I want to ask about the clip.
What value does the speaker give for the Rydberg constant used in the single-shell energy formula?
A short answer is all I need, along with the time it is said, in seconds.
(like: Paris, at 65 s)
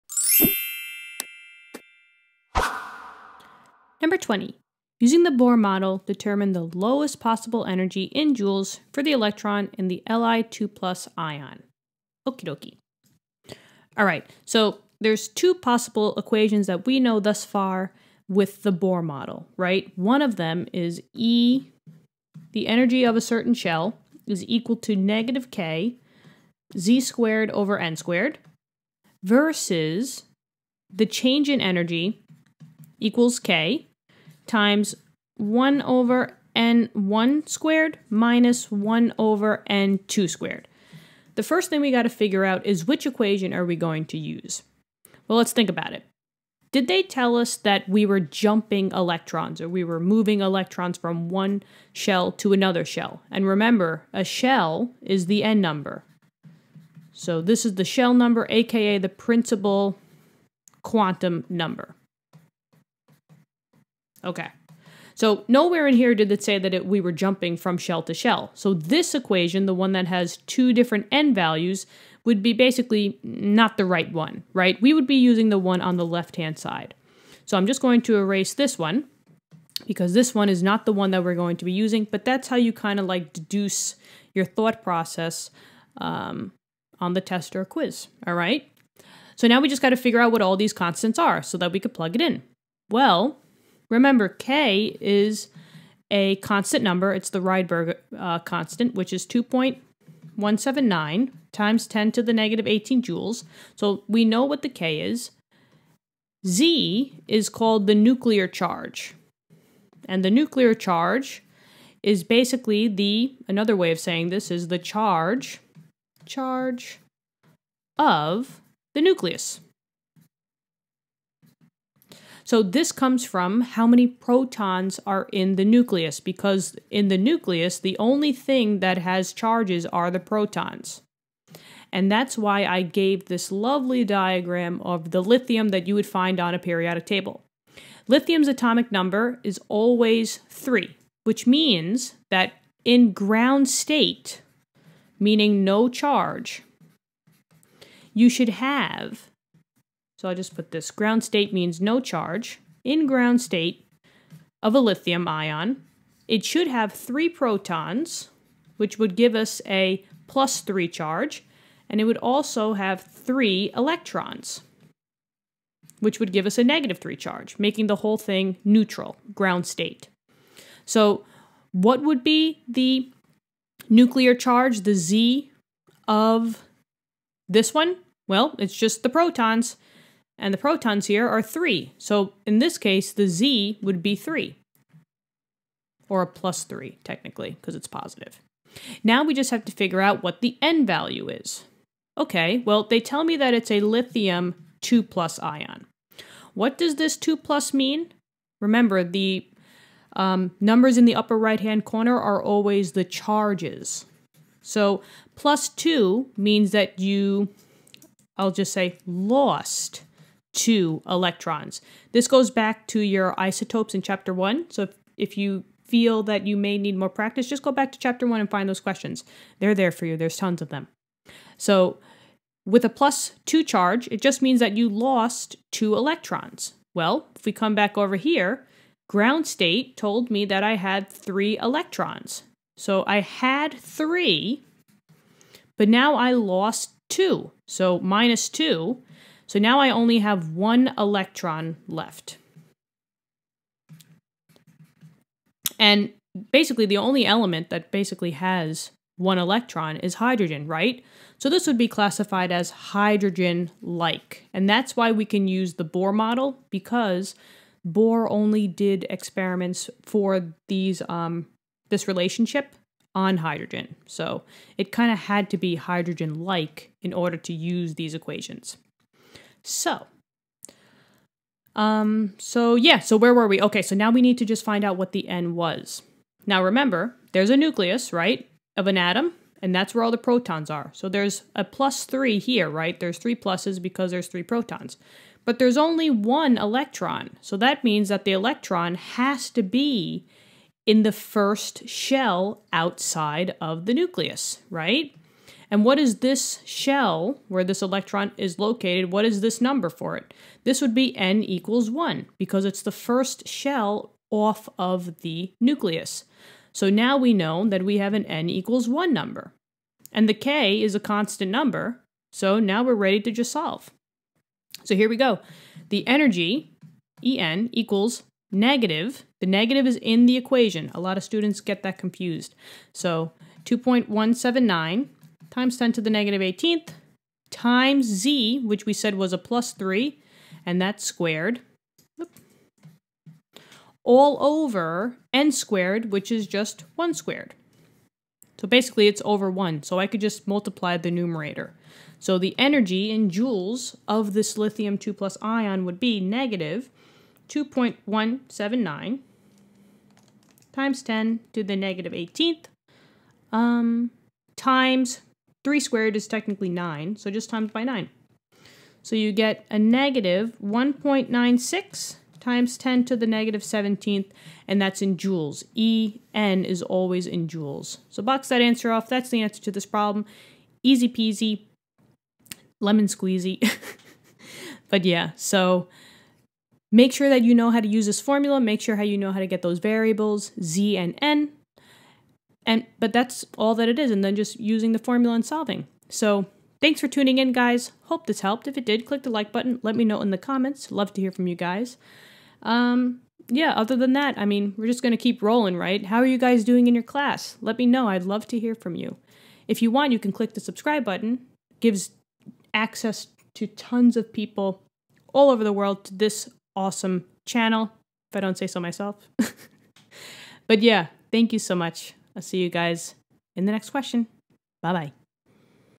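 2.179 x 10^-18 J, at 99 s.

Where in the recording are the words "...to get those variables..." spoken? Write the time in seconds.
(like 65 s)
379 s.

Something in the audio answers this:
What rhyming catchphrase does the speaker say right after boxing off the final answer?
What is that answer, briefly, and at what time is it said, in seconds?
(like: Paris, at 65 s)
Easy peasy, lemon squeezy, at 370 s.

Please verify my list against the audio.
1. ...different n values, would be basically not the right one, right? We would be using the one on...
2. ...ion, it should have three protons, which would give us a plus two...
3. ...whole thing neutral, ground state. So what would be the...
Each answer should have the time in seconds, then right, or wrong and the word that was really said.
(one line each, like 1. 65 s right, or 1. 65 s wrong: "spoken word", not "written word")
1. 70 s right
2. 155 s wrong: "three", not "two"
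3. 168 s right.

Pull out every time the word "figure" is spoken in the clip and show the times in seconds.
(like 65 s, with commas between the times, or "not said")
42 s, 89 s, 189 s.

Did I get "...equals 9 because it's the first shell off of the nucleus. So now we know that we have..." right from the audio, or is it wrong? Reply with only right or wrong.
wrong.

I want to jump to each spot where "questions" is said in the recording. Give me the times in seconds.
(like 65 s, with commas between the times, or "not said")
218 s, 413 s.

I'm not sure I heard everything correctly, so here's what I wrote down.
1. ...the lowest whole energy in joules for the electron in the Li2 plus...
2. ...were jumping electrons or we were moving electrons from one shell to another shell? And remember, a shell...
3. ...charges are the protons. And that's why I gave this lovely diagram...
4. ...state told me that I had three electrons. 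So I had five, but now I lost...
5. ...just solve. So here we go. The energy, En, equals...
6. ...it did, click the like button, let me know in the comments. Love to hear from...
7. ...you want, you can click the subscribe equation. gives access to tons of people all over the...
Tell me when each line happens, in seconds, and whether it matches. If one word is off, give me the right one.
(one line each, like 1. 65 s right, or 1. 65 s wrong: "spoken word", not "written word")
1. 6 s wrong: "possible", not "whole"
2. 48 s right
3. 129 s right
4. 229 s wrong: "three", not "five"
5. 313 s right
6. 388 s right
7. 399 s wrong: "button", not "equation".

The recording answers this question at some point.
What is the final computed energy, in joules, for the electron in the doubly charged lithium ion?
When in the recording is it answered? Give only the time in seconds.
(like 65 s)
359 s.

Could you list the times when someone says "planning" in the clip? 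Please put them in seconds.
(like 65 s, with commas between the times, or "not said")
not said.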